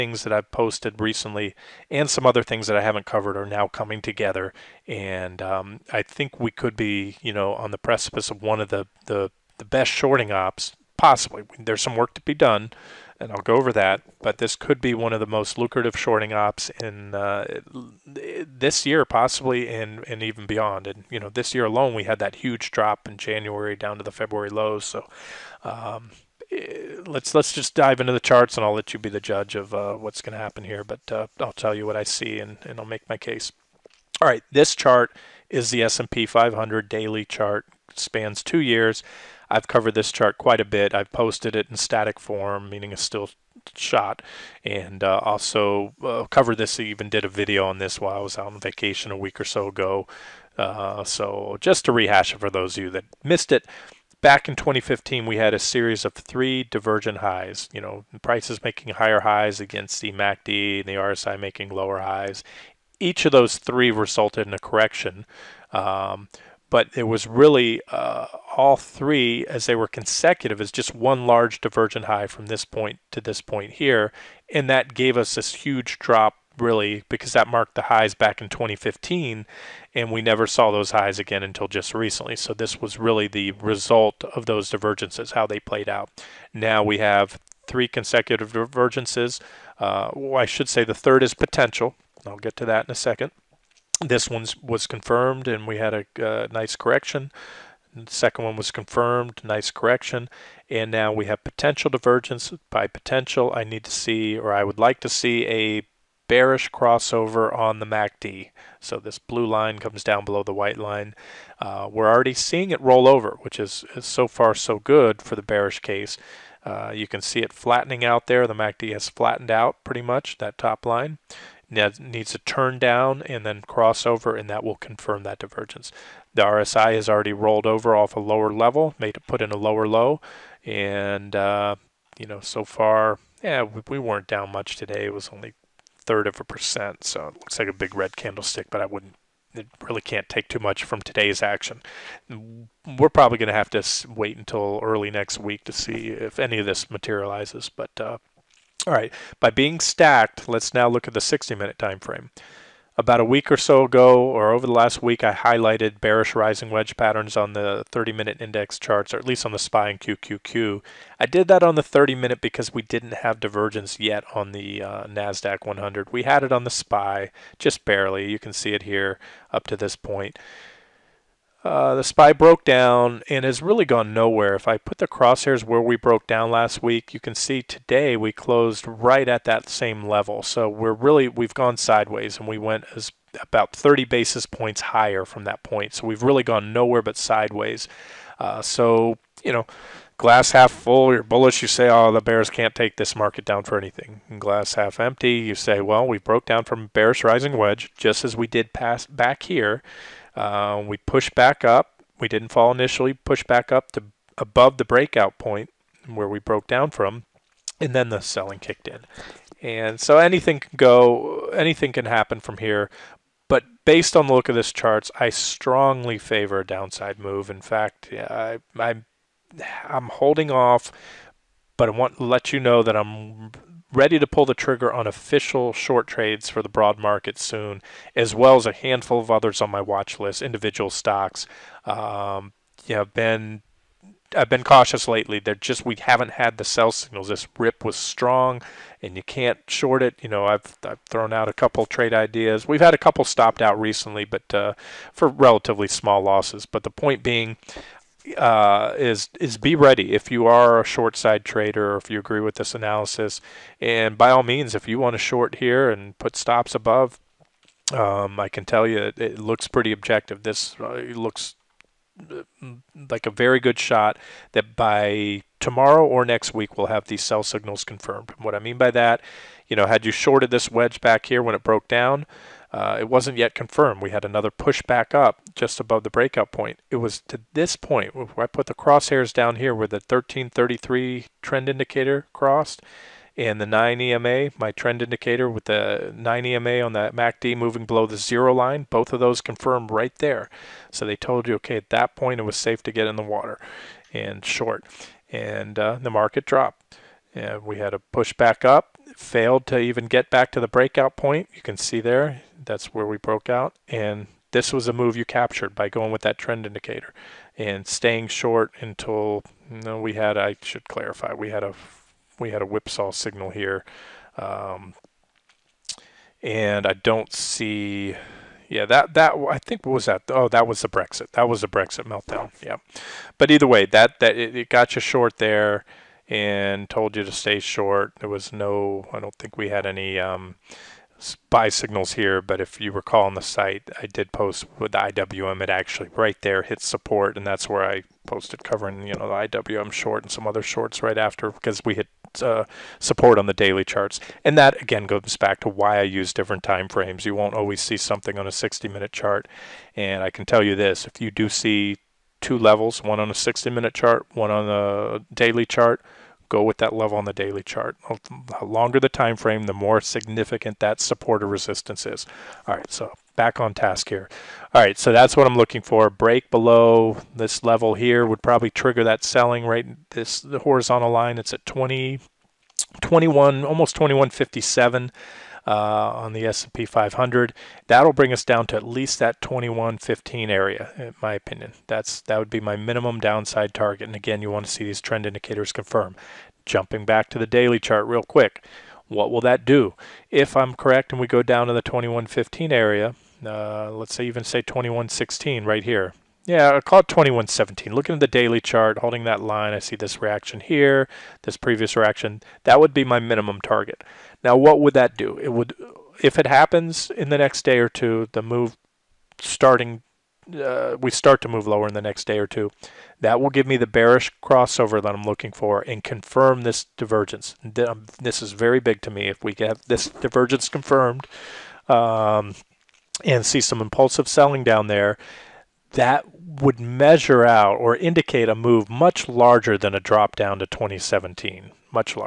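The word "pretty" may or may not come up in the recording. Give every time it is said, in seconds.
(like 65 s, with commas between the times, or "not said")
119 s, 259 s.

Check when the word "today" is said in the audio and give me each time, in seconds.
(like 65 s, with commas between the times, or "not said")
134 s, 141 s, 177 s.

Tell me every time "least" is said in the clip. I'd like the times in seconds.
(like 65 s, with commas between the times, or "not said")
159 s, 378 s.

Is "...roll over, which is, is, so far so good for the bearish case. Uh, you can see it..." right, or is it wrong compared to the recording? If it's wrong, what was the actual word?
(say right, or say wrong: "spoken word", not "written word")
right.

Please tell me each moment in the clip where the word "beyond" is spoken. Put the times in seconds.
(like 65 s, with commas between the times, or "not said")
20 s.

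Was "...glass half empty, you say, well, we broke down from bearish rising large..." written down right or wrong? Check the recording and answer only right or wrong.
wrong.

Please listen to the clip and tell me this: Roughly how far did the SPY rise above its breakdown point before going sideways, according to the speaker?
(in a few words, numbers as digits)
30 basis points.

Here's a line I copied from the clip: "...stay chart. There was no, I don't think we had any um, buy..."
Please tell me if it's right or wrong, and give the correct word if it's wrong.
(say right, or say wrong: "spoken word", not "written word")
wrong: "short", not "chart".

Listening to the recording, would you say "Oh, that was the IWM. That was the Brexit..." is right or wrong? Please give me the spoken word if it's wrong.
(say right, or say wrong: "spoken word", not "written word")
wrong: "Brexit", not "IWM".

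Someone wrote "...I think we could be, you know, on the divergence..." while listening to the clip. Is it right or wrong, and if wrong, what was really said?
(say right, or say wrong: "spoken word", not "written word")
wrong: "precipice", not "divergence".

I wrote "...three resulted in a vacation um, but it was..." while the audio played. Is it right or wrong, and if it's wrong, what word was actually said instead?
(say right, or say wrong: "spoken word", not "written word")
wrong: "correction", not "vacation".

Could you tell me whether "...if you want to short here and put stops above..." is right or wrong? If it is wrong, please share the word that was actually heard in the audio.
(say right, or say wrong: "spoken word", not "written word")
right.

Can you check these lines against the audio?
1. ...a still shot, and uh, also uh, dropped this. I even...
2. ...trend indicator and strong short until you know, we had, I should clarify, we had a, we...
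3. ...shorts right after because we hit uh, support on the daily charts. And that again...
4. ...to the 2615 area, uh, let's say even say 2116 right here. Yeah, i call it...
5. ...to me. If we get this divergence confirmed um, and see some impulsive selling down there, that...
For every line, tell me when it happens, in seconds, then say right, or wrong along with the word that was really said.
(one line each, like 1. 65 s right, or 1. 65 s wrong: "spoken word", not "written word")
1. 42 s wrong: "covered", not "dropped"
2. 306 s wrong: "staying", not "strong"
3. 340 s right
4. 391 s wrong: "2115", not "2615"
5. 419 s right.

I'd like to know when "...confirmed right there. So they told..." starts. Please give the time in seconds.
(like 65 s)
289 s.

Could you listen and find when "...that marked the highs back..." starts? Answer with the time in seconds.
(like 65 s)
77 s.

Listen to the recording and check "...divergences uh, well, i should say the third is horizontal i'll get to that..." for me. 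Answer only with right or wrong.
wrong.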